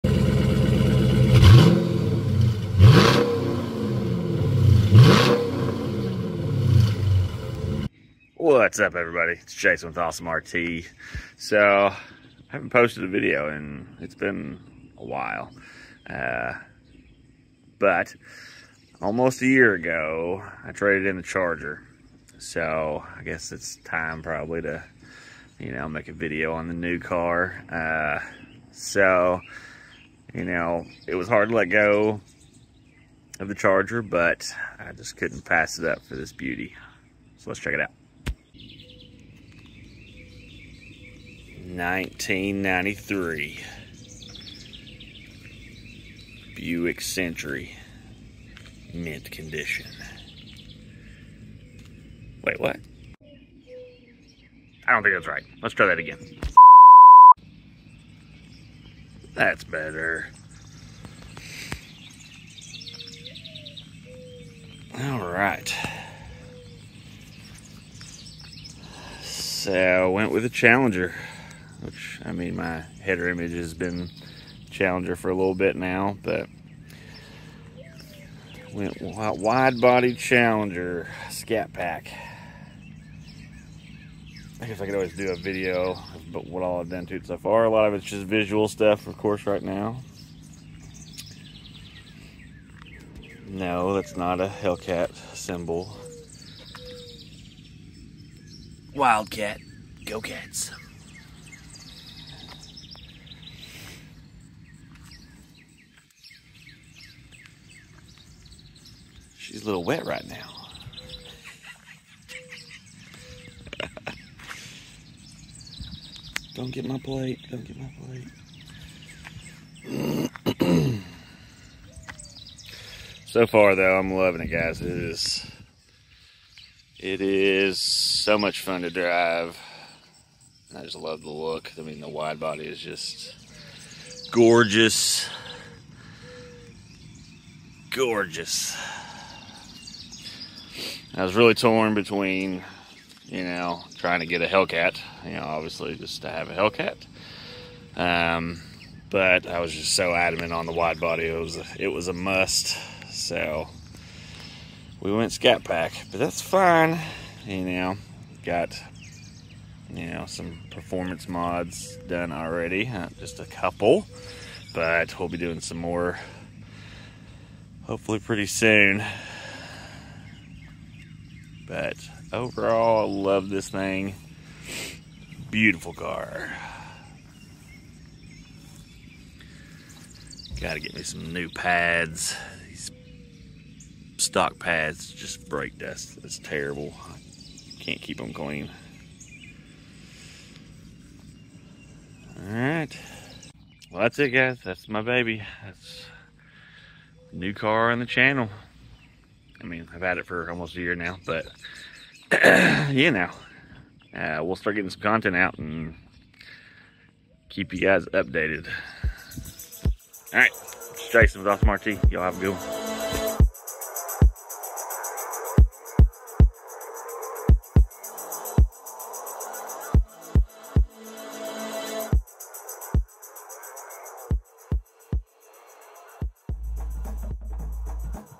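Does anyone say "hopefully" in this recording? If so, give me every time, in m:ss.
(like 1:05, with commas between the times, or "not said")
2:47.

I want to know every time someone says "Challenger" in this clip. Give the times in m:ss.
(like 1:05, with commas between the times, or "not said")
1:10, 1:14, 1:20.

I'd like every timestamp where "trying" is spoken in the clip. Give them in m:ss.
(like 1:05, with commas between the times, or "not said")
2:23.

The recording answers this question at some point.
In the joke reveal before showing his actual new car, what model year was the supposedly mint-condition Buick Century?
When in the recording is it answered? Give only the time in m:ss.
0:41.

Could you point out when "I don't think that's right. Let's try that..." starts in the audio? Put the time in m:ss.
0:54.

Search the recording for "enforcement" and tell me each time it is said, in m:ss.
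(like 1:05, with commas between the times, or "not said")
not said.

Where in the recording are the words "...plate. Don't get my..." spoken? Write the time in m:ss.
1:56.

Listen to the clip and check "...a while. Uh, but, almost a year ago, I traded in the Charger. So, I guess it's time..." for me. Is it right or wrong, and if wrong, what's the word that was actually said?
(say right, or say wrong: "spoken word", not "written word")
right.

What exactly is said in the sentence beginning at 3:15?
That's new car on the channel.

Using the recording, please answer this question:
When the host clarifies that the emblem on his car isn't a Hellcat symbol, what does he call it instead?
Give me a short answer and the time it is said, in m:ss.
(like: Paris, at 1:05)
Wildcat, at 1:38.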